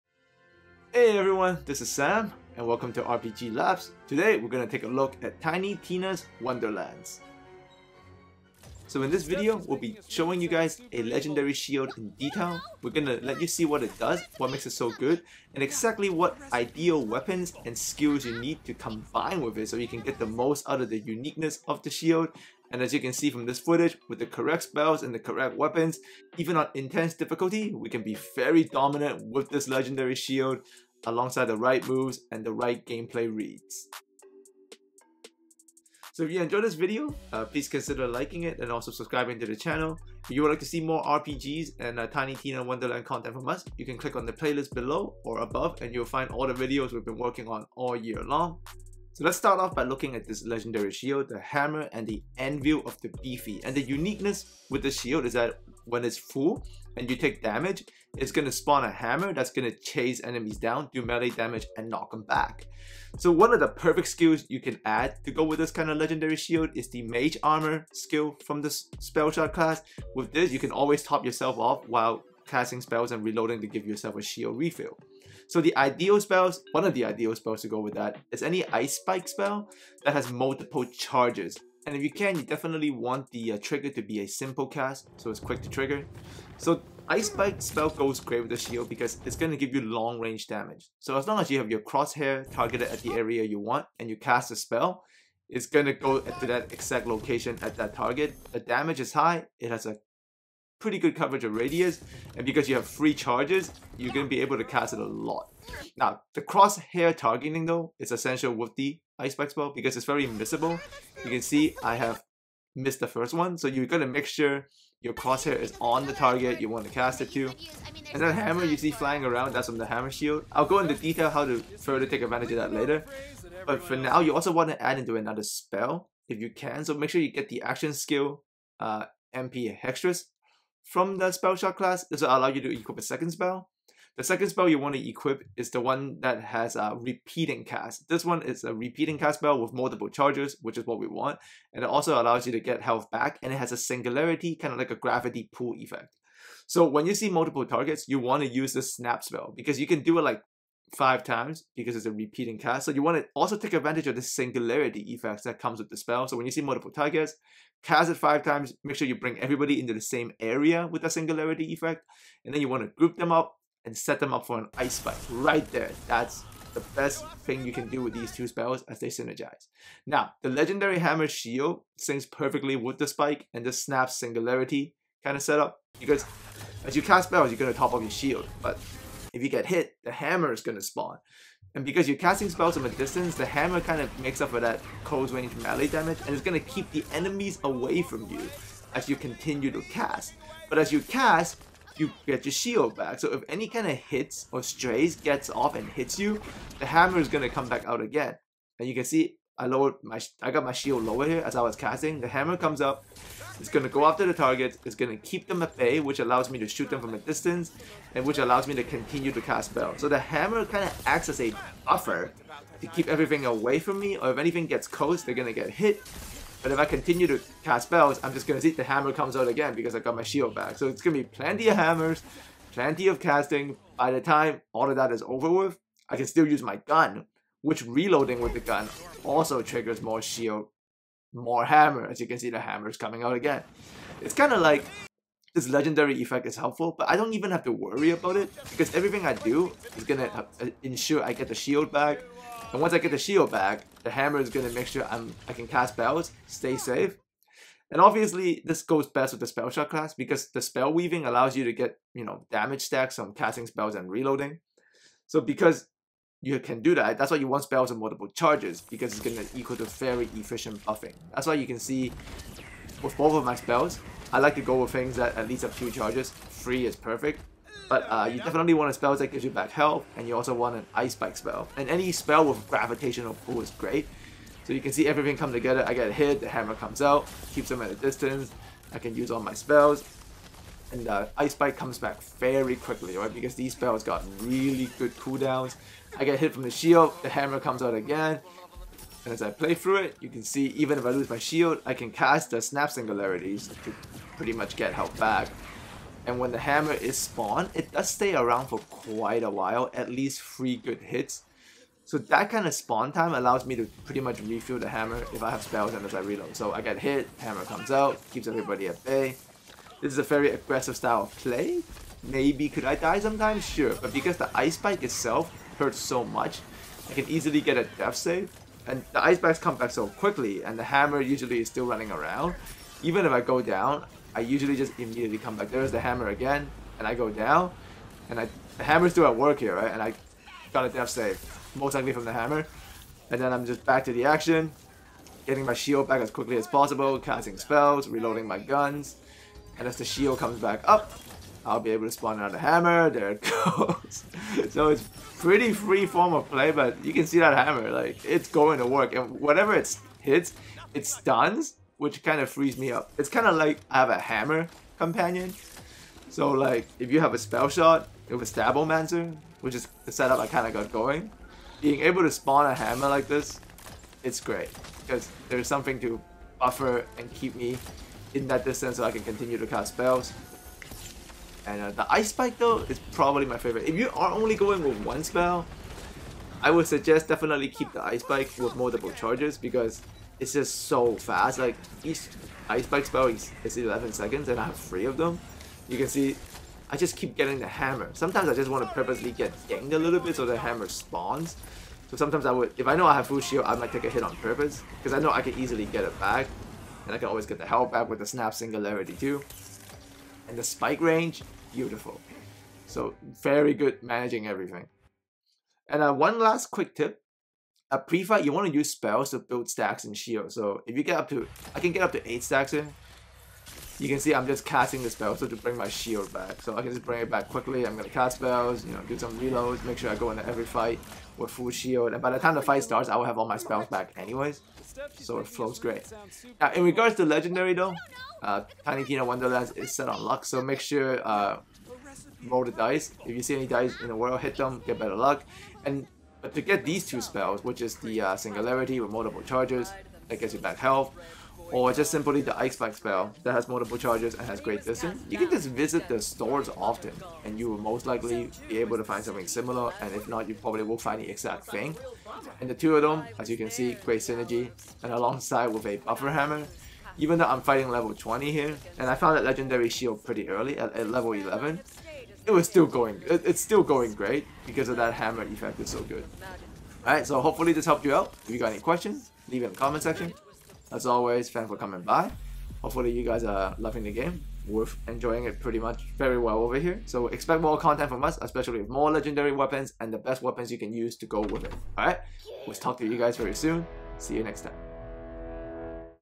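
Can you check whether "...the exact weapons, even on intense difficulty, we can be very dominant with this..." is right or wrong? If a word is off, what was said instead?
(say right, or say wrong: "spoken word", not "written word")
wrong: "correct", not "exact".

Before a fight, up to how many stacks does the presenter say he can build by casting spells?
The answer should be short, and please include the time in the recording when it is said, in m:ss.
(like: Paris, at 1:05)
8, at 6:52.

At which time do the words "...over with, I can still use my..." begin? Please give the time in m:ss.
3:45.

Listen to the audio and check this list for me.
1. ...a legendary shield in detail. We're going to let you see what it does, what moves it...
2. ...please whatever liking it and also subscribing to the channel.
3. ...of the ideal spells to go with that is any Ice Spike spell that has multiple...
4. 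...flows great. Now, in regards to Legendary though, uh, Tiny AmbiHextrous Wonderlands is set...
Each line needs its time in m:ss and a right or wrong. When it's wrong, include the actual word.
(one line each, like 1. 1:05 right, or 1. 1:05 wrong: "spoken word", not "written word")
1. 0:10 wrong: "makes", not "moves"
2. 0:37 wrong: "consider", not "whatever"
3. 1:16 right
4. 7:05 wrong: "Tina", not "AmbiHextrous".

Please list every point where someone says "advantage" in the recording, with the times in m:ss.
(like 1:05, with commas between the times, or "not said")
2:02, 2:33.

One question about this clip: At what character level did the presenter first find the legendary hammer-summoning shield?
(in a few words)
11.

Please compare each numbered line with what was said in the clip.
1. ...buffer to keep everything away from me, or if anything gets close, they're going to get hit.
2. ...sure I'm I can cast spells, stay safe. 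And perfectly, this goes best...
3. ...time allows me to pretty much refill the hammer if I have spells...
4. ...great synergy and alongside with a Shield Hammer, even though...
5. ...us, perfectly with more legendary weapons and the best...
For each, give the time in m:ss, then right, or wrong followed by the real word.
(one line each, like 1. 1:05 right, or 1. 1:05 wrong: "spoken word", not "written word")
1. 3:31 right
2. 4:04 wrong: "obviously", not "perfectly"
3. 5:03 right
4. 7:33 wrong: "Buffer", not "Shield"
5. 7:58 wrong: "especially", not "perfectly".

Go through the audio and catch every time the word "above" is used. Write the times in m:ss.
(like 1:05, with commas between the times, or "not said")
0:45.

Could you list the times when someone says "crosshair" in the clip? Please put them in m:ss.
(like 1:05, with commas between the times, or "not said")
1:31, 1:46, 1:55.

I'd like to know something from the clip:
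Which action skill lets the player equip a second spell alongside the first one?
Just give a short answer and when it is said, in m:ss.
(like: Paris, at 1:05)
Ambi-Hextrous, at 2:09.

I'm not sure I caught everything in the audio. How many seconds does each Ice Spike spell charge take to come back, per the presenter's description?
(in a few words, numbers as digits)
11.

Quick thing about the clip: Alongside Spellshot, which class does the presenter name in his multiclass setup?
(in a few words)
Stabbomancer.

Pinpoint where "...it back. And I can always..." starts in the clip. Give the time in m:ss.
6:36.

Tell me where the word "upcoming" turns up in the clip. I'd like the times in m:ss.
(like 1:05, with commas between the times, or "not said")
not said.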